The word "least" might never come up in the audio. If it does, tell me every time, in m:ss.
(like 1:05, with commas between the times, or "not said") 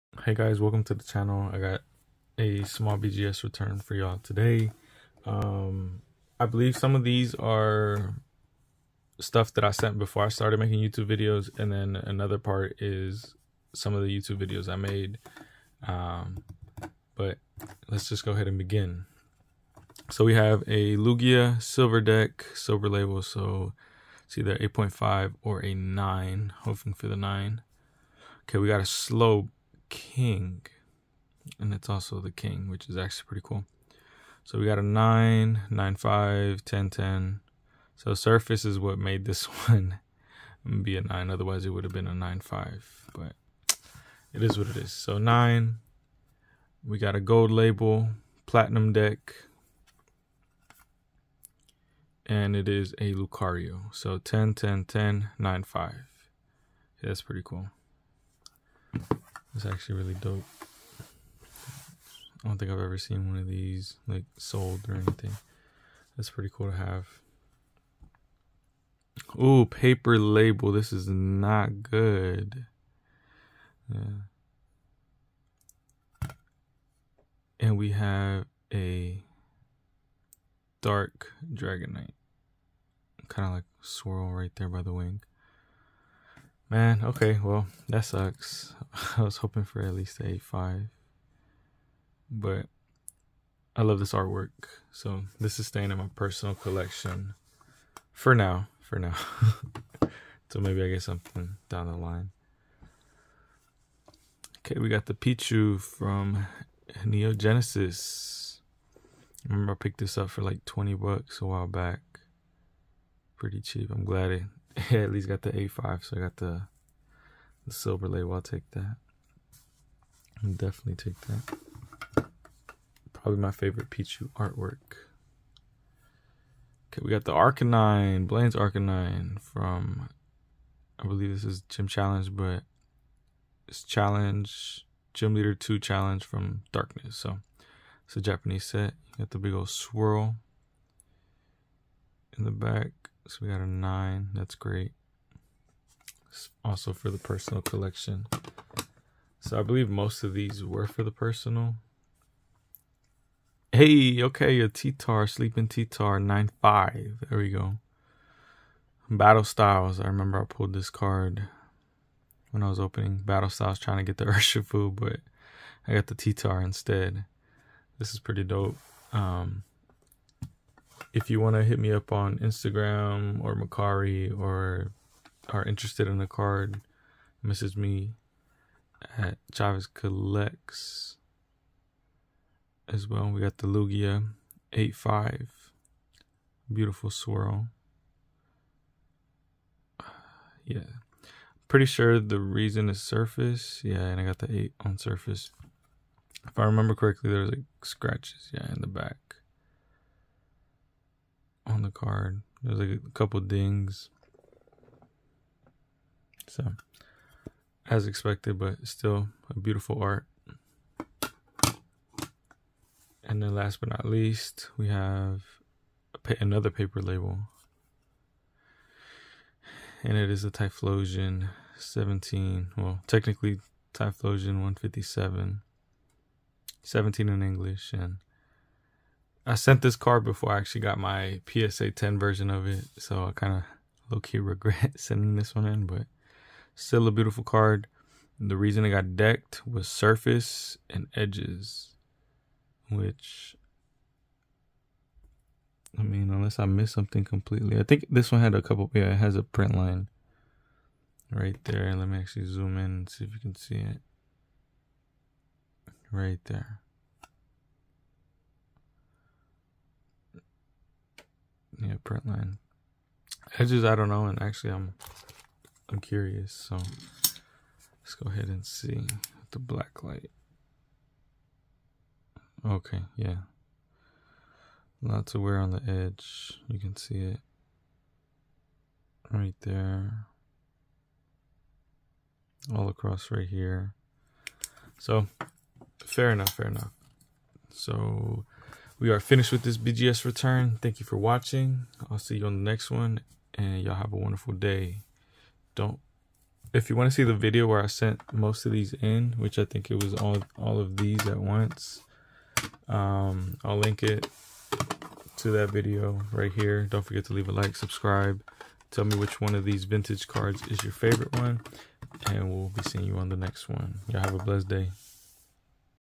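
1:29, 1:55, 3:34.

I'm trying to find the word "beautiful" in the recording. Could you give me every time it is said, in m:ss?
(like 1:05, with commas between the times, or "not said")
3:06, 3:29, 3:57.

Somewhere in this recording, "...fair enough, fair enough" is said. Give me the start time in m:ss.
4:46.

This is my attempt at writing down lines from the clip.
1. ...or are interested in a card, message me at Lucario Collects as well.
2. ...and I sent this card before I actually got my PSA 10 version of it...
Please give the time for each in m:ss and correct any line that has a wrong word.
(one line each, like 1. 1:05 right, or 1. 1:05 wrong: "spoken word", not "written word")
1. 2:54 wrong: "Chavez", not "Lucario"
2. 3:47 right.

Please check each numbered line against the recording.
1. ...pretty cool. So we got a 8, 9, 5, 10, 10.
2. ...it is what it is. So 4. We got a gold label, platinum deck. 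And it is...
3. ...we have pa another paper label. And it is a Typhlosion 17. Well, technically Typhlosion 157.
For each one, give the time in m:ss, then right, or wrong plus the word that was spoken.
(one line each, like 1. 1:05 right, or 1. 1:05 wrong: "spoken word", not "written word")
1. 0:33 wrong: "9", not "8"
2. 0:44 wrong: "9", not "4"
3. 3:34 right.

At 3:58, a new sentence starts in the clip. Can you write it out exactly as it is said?
The reason it got decked was surface and edges, which I mean, unless I missed something completely.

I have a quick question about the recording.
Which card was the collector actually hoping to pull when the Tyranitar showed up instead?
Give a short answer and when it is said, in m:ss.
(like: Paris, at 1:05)
Urshifu, at 2:44.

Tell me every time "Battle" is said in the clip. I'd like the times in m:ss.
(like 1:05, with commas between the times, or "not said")
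2:39, 2:43.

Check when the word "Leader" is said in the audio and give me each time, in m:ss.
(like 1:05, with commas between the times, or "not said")
2:15.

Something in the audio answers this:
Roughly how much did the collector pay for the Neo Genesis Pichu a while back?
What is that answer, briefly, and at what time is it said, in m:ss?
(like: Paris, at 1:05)
$20, at 1:50.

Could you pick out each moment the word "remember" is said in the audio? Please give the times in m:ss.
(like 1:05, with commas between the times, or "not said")
1:49, 2:40, 3:16.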